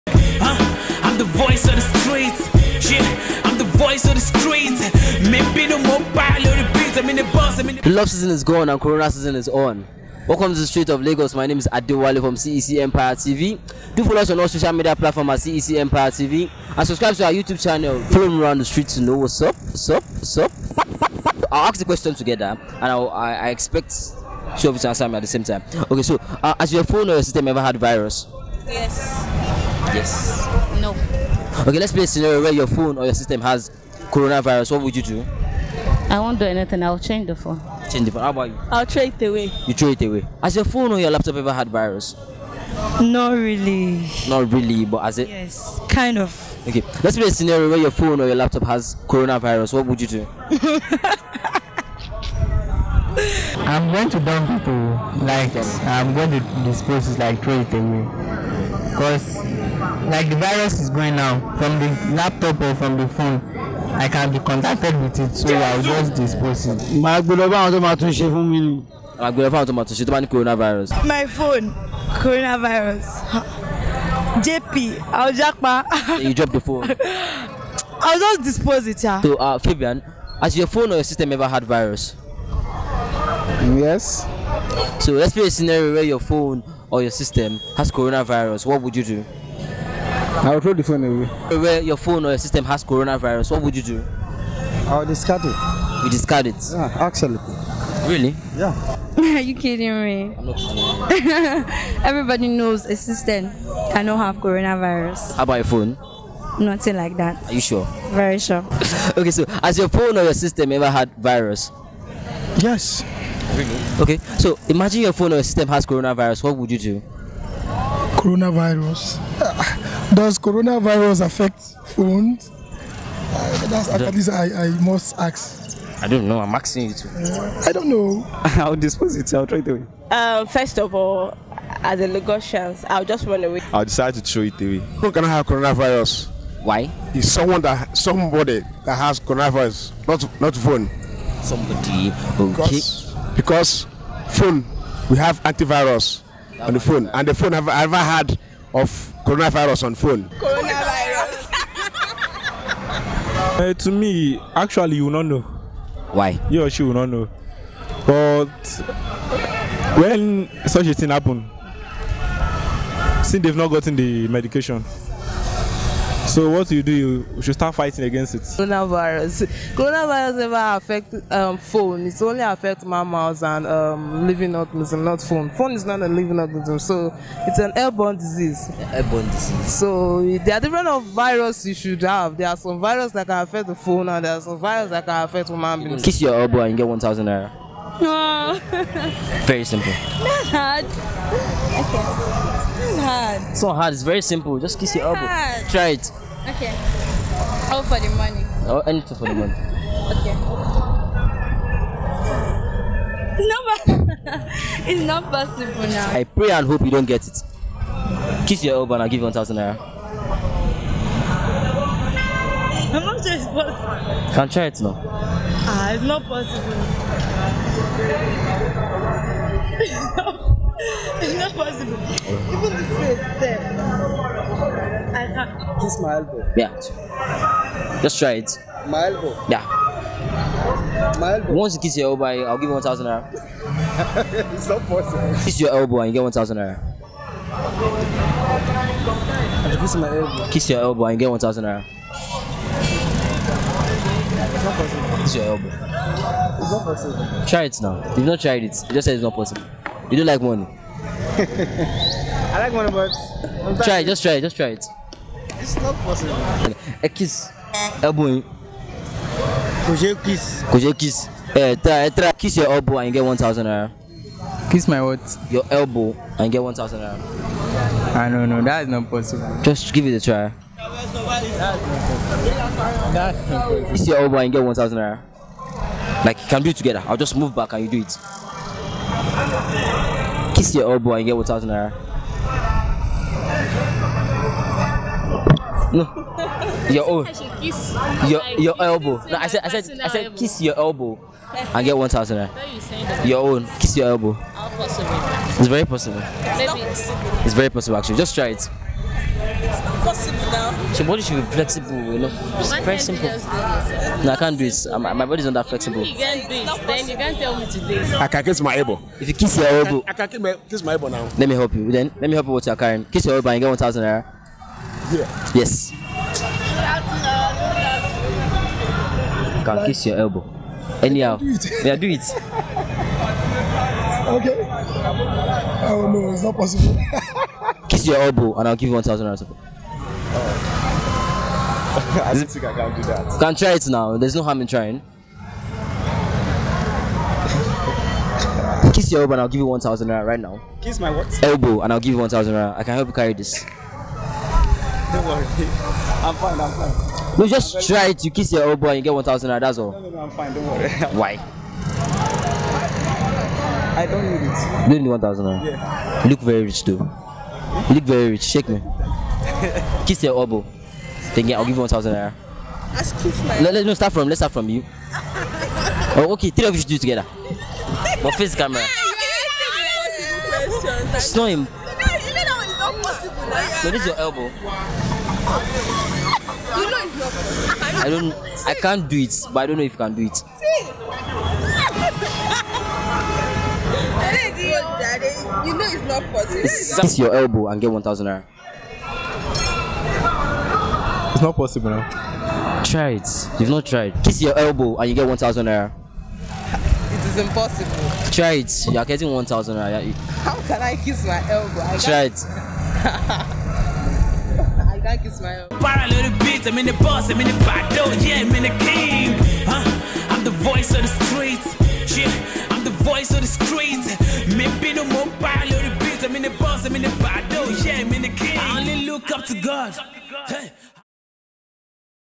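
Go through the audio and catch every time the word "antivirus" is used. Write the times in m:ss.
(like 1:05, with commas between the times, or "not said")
2:25.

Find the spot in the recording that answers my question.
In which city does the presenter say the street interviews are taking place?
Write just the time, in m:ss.
0:11.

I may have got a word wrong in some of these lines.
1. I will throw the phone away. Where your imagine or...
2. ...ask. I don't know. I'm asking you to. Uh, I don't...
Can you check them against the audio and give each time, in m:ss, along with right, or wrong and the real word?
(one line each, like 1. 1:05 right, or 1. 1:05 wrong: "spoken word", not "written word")
1. 1:30 wrong: "phone", not "imagine"
2. 2:05 right.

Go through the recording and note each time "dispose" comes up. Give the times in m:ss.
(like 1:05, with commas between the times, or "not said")
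0:56, 1:06, 1:18, 2:08.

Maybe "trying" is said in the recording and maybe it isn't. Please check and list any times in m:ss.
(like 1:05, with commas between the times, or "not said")
5:34.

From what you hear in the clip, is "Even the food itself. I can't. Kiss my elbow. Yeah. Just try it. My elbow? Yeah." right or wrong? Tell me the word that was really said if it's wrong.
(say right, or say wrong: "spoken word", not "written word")
right.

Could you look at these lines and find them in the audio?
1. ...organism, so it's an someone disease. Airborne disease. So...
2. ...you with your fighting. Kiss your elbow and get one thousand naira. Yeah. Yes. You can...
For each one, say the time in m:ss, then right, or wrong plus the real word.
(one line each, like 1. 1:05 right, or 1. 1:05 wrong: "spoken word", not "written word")
1. 2:56 wrong: "airborne", not "someone"
2. 5:12 wrong: "carrying", not "fighting".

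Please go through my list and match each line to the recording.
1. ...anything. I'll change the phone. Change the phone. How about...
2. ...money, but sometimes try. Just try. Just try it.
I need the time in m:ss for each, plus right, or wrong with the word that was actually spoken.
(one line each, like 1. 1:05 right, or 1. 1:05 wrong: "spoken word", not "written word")
1. 0:36 right
2. 4:12 right.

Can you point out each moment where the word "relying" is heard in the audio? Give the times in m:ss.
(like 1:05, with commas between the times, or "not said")
not said.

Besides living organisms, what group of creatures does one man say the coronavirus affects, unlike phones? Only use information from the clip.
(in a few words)
mammals.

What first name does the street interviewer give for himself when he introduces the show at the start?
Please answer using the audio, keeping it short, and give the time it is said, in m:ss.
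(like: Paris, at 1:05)
Adewale, at 0:11.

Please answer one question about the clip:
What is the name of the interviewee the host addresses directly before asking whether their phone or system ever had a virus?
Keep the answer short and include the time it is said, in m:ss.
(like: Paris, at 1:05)
Fabian, at 1:19.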